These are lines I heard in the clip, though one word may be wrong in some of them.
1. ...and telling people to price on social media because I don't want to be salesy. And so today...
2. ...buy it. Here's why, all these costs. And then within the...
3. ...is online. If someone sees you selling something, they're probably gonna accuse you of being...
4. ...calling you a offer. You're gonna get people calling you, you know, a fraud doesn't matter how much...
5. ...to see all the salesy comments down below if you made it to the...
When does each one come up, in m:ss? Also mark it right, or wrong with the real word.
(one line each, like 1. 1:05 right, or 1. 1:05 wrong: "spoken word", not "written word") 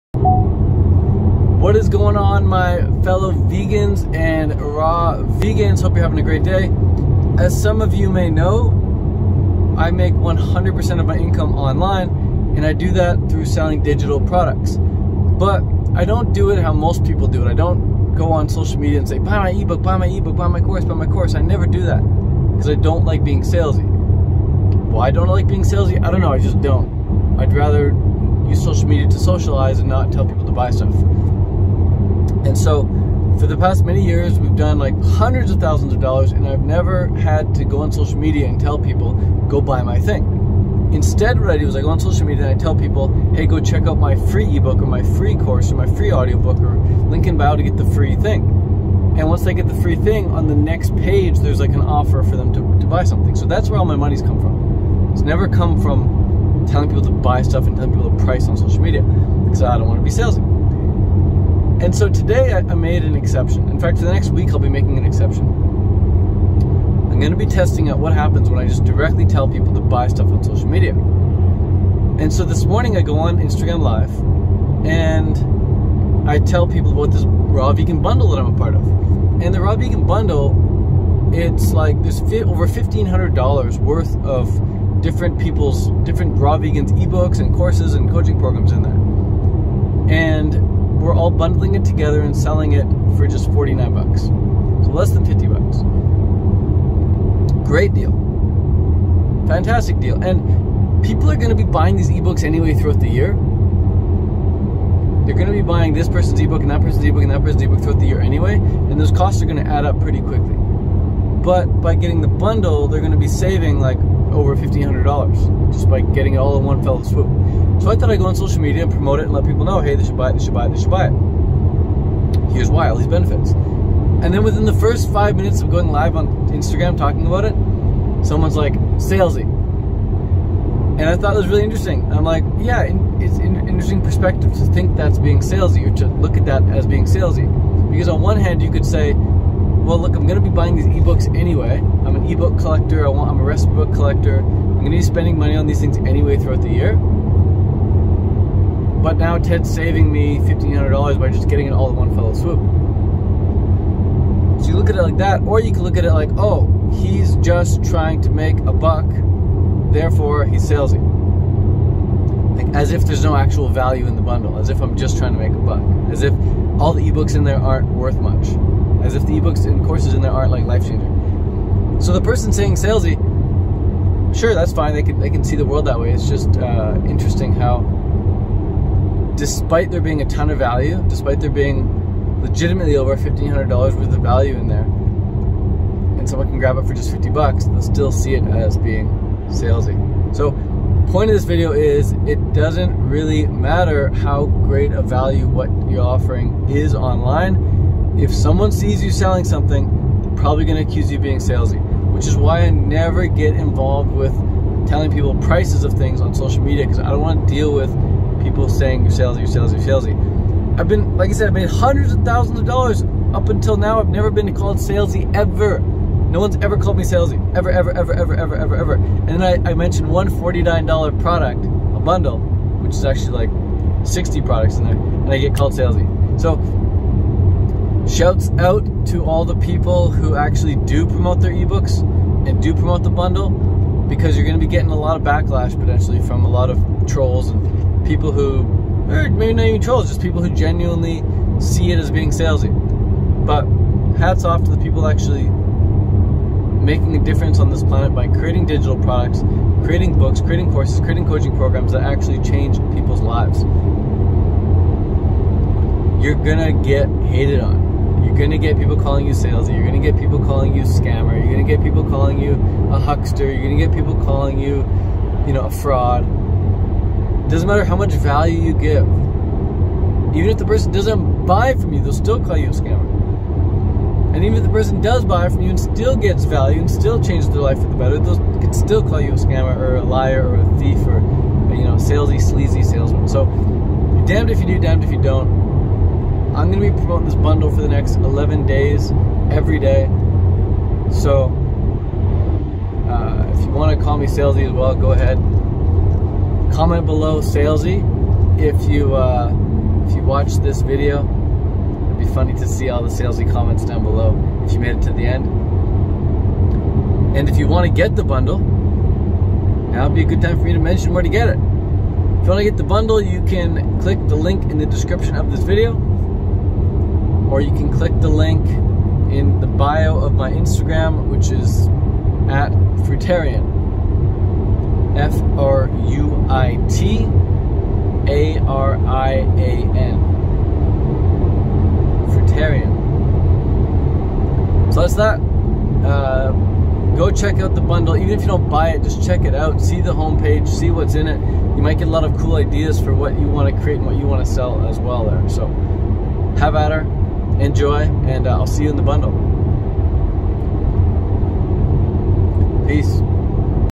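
1. 0:57 right
2. 2:00 wrong: "benefits", not "costs"
3. 3:16 right
4. 4:22 wrong: "huckster", not "offer"
5. 5:02 right.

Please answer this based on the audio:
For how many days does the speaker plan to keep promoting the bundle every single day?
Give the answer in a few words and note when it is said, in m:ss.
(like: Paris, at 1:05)
11, at 4:48.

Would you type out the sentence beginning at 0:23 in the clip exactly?
Why don't I like being salesy?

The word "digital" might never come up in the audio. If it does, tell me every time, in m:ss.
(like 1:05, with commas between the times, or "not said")
0:13, 4:08.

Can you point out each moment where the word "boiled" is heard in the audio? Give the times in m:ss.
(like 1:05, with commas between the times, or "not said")
not said.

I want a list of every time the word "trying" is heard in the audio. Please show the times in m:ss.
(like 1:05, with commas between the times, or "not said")
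2:37, 2:45.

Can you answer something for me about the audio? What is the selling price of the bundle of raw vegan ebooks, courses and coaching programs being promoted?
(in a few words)
$49.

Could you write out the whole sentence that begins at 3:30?
I've been, like I said, I've made hundreds of thousands of dollars up until now.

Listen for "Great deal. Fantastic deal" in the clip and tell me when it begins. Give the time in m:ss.
1:37.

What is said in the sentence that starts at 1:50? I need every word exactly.
But by getting the bundle, they're going to be saving like over $1,500 just by getting it all in one fell swoop.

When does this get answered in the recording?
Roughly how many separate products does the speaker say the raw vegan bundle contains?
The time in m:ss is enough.
3:44.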